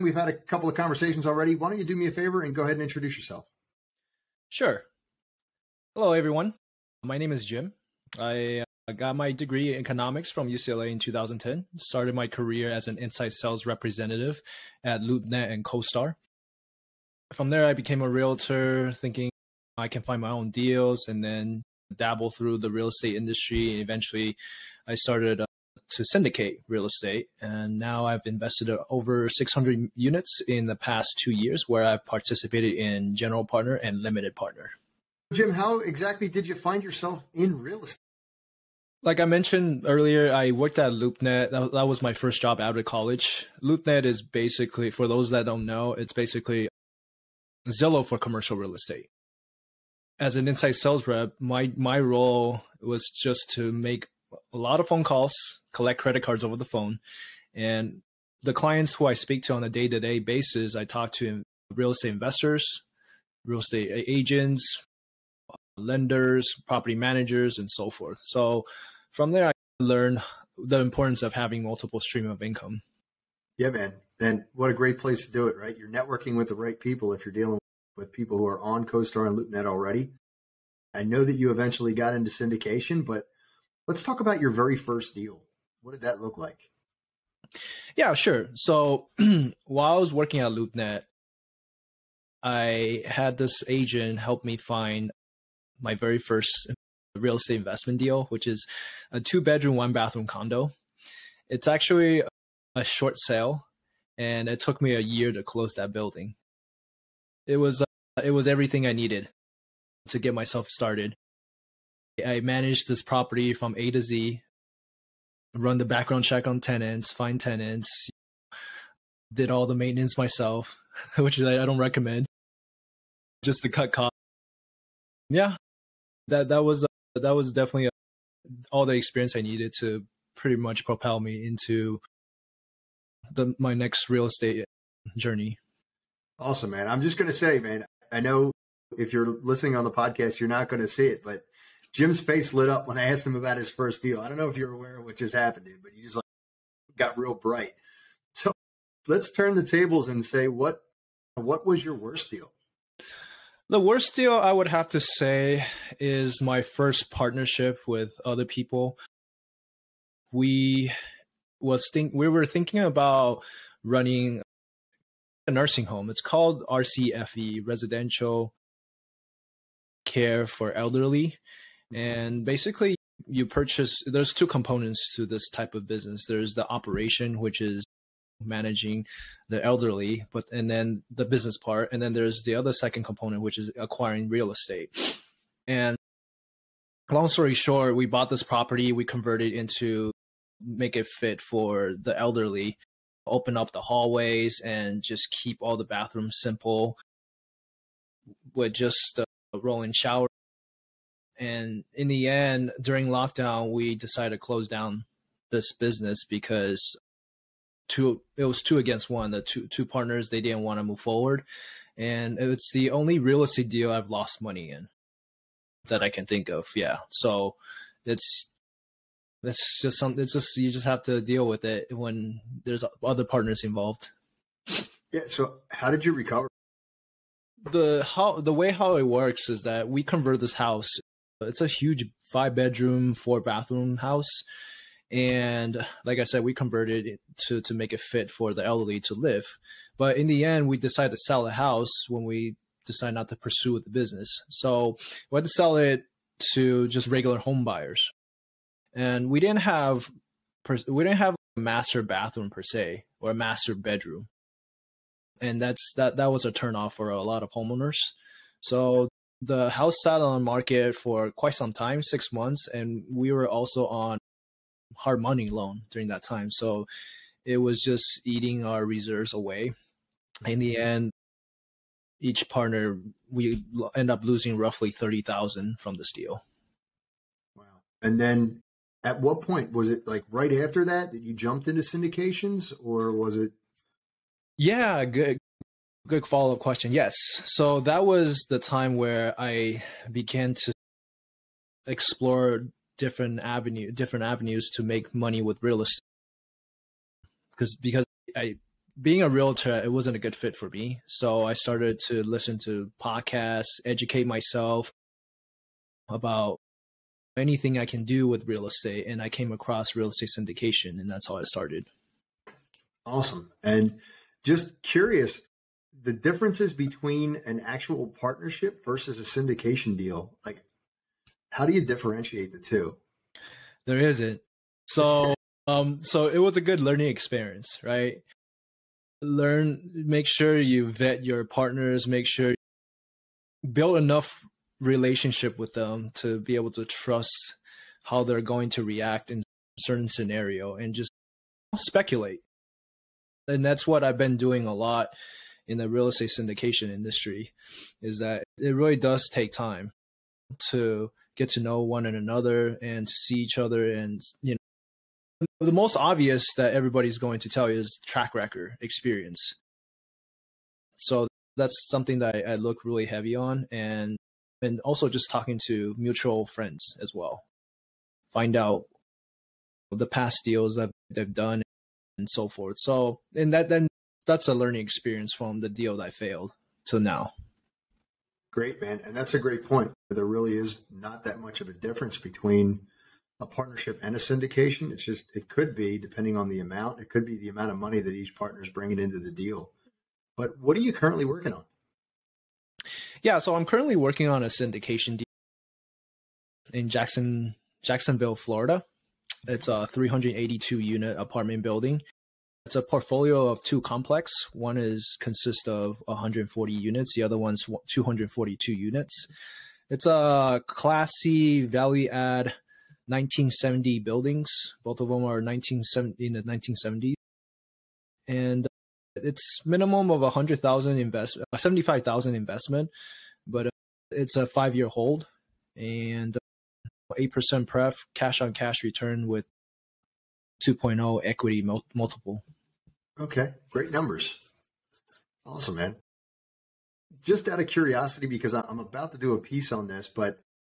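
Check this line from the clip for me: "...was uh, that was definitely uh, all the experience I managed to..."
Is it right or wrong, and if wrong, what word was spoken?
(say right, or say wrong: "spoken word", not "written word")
wrong: "needed", not "managed".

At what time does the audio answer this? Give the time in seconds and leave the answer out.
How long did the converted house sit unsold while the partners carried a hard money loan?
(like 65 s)
262 s.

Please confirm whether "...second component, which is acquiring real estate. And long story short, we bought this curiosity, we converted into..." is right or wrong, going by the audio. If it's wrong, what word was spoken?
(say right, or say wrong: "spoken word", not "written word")
wrong: "property", not "curiosity".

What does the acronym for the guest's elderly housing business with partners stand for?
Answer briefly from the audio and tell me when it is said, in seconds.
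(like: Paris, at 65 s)
Residential Care for Elderly, at 167 s.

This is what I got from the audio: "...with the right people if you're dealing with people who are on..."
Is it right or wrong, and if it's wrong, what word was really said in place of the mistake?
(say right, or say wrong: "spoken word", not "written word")
right.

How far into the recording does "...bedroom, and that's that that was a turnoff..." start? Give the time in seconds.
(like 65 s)
253 s.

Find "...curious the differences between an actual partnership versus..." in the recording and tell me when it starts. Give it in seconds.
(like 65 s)
314 s.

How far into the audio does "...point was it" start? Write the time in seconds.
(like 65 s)
279 s.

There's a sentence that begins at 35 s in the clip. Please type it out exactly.
Jim, how exactly did you find yourself in real estate?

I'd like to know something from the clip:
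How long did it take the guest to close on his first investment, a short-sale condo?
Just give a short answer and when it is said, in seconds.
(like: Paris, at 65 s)
a year, at 104 s.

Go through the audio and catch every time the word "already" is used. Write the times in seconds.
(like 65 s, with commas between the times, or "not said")
1 s, 79 s.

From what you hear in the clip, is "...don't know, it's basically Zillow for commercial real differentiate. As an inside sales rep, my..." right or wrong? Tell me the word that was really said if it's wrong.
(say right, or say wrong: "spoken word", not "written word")
wrong: "estate", not "differentiate".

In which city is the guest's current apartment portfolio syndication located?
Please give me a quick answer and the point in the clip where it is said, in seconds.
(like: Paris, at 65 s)
Jacksonville, Florida, at 397 s.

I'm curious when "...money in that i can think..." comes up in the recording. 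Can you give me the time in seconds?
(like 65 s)
214 s.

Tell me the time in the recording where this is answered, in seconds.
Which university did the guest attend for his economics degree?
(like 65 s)
10 s.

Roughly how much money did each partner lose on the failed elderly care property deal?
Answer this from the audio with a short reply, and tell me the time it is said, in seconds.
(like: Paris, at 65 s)
$30,000, at 274 s.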